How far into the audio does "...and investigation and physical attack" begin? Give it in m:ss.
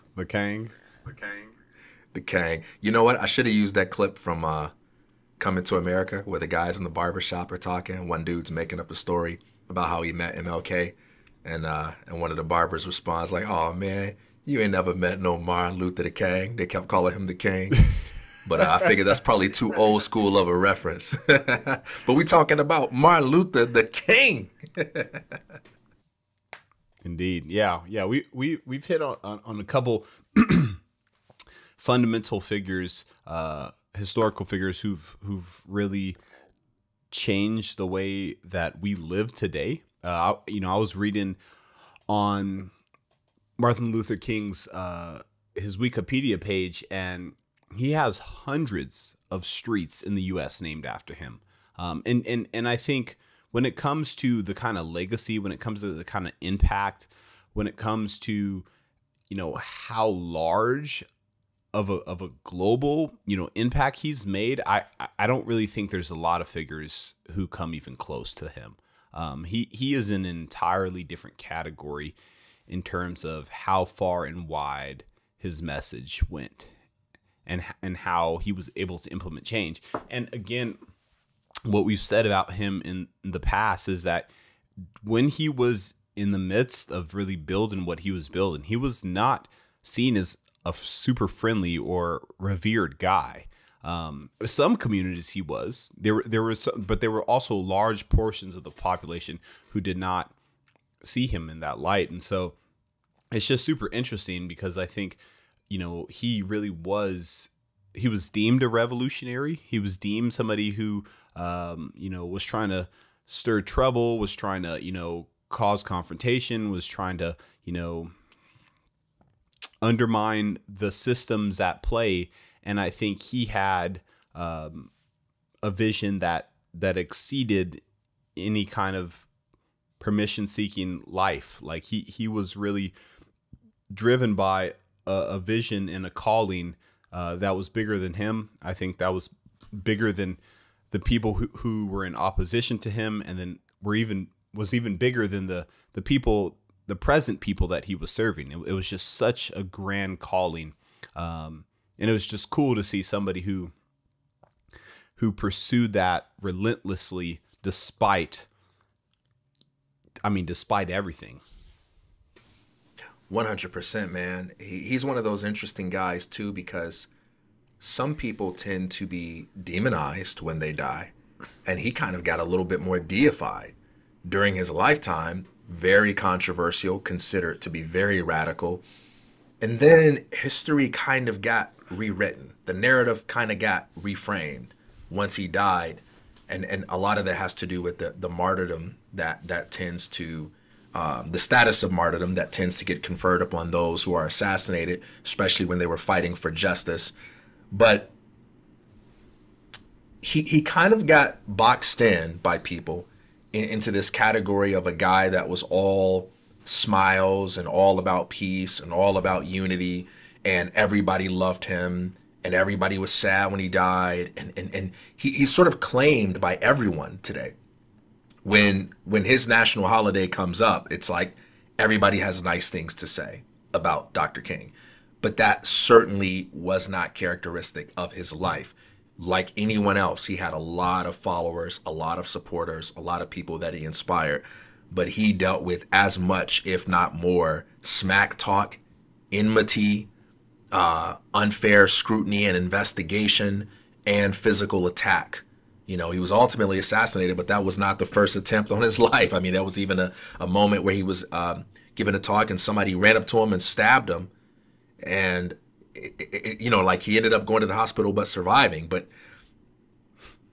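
4:02.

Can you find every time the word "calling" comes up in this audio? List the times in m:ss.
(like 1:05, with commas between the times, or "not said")
0:16, 2:16, 2:30.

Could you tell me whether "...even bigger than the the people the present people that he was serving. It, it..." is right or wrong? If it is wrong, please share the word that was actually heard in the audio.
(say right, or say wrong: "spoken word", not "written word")
right.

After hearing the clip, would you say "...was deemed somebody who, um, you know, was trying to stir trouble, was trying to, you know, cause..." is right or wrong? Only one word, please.
right.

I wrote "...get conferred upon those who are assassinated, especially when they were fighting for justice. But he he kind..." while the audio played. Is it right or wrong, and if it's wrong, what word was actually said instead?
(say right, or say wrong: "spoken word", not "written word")
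right.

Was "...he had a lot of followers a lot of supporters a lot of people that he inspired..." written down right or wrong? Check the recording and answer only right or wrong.
right.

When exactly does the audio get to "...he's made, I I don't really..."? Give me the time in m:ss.
1:03.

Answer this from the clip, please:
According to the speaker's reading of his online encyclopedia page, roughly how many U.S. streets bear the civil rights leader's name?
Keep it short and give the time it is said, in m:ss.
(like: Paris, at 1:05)
hundreds, at 0:48.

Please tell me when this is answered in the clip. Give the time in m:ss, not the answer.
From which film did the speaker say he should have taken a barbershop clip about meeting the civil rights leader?
0:05.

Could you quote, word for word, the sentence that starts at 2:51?
And he kind of got a little bit more deified during his lifetime, very controversial, considered to be very radical.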